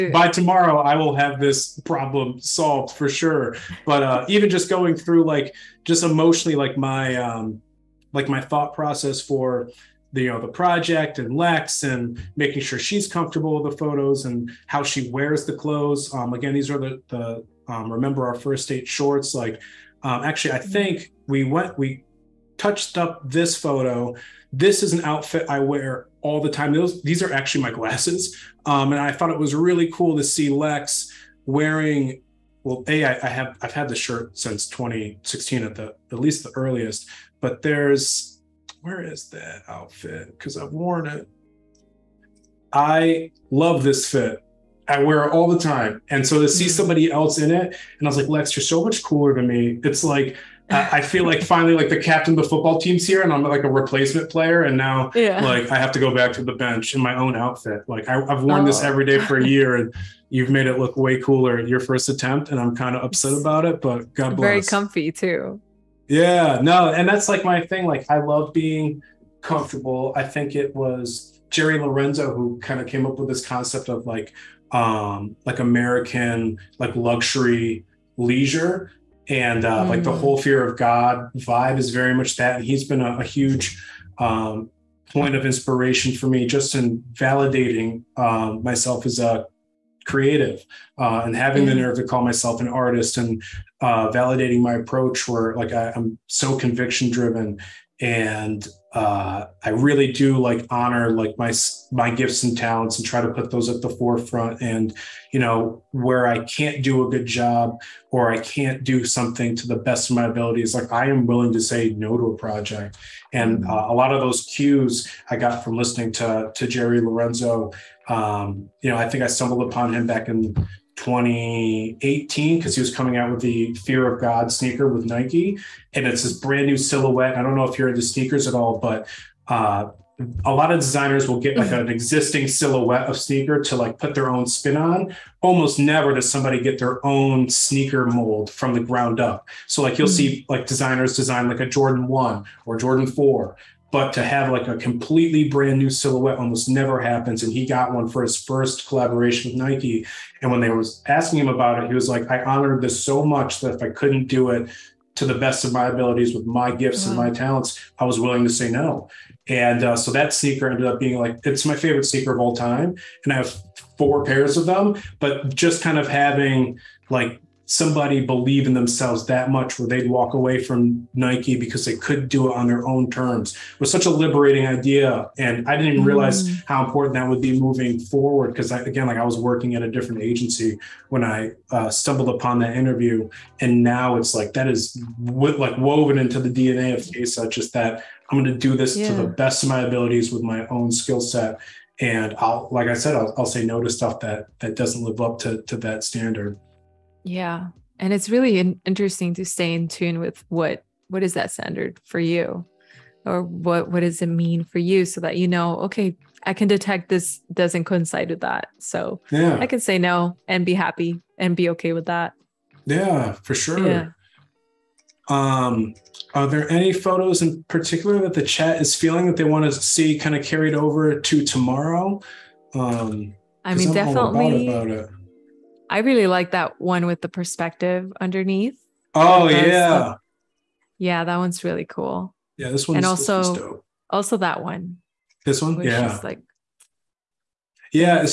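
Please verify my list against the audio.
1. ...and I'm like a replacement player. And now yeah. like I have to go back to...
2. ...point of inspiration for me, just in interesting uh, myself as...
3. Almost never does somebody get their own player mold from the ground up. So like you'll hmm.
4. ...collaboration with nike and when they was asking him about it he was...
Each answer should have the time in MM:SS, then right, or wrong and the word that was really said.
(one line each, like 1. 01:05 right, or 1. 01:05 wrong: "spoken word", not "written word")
1. 00:53 right
2. 01:25 wrong: "validating", not "interesting"
3. 02:15 wrong: "sneaker", not "player"
4. 02:28 right.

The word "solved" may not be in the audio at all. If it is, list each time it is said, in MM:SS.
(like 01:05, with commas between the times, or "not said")
00:02.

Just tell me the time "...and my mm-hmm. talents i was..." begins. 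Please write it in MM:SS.
02:37.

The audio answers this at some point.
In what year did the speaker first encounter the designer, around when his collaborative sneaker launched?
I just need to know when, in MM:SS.
02:00.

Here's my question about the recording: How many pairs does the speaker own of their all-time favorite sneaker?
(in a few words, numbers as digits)
4.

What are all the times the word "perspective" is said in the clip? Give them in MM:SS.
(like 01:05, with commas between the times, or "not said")
03:47.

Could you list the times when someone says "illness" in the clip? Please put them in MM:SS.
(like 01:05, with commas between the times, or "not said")
not said.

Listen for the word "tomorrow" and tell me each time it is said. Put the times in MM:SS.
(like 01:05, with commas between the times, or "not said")
00:00, 03:41.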